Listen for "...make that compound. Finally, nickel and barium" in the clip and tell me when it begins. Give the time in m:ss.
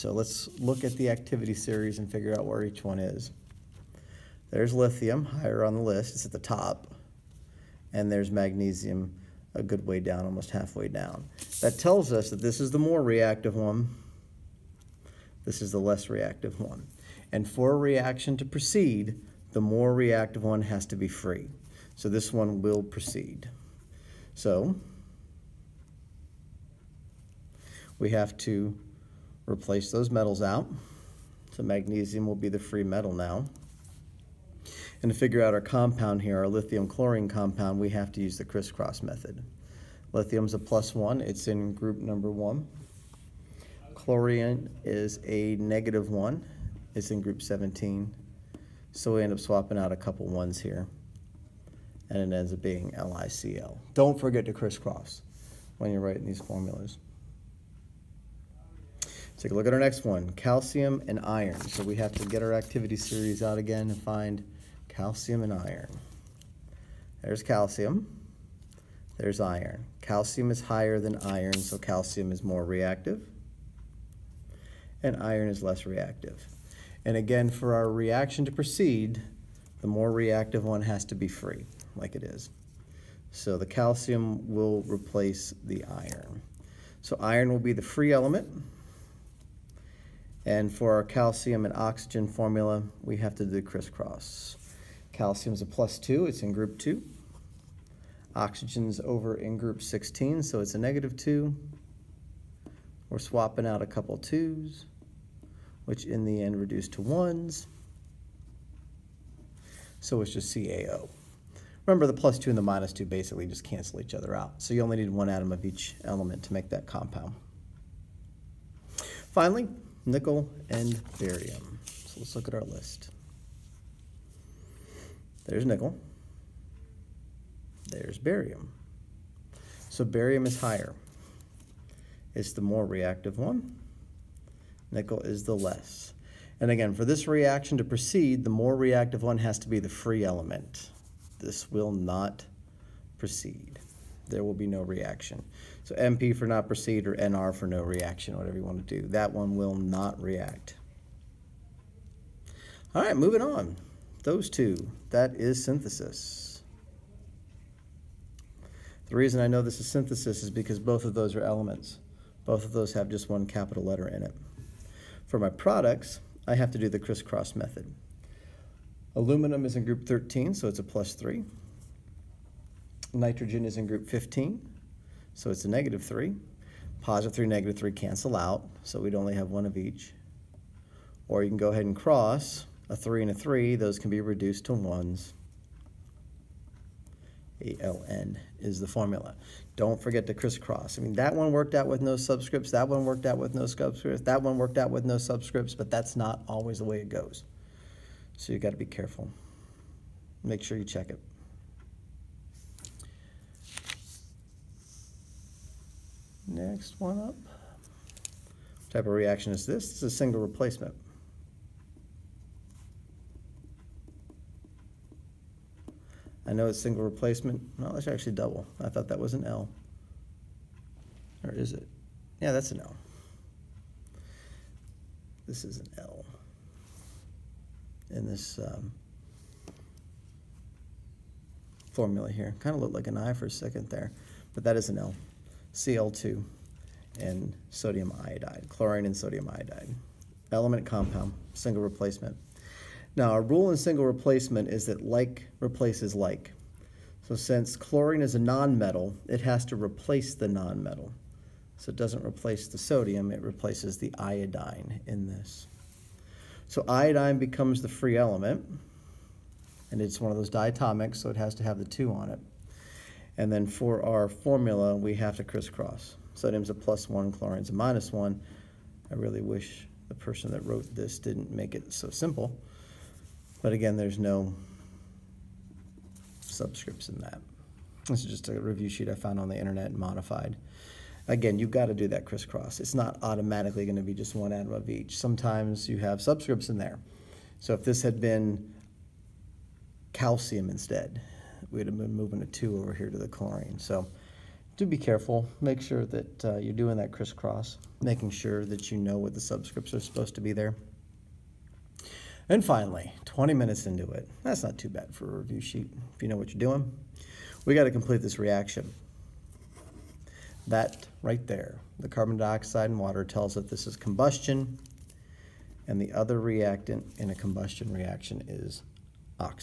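1:56.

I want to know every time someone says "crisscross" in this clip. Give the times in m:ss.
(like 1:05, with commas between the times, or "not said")
0:38, 0:54, 1:33, 2:46, 3:10, 4:25, 4:42, 4:57.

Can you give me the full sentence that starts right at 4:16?
So iodine becomes the free element, and it's one of those diatomics, so it has to have the two on it.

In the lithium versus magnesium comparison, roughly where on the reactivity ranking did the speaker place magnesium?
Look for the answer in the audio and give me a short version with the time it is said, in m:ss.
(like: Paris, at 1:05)
almost halfway down, at 0:10.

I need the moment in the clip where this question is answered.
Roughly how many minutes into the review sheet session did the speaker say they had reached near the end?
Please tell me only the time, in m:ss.
5:03.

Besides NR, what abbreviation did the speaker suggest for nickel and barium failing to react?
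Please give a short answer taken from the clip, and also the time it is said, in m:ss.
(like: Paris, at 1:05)
NP, at 2:25.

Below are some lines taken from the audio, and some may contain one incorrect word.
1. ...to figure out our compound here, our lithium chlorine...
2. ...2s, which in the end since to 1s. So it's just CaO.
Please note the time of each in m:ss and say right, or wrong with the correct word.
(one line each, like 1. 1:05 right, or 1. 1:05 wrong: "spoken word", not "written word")
1. 0:35 right
2. 1:44 wrong: "reduce", not "since".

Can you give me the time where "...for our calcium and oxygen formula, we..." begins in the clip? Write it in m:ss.
1:30.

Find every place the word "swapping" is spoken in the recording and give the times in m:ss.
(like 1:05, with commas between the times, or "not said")
0:49, 1:43.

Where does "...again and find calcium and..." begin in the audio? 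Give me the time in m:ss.
1:03.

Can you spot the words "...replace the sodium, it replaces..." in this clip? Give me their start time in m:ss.
4:12.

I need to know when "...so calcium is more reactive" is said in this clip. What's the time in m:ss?
1:11.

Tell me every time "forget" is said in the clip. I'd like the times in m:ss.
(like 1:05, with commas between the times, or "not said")
0:54, 3:10.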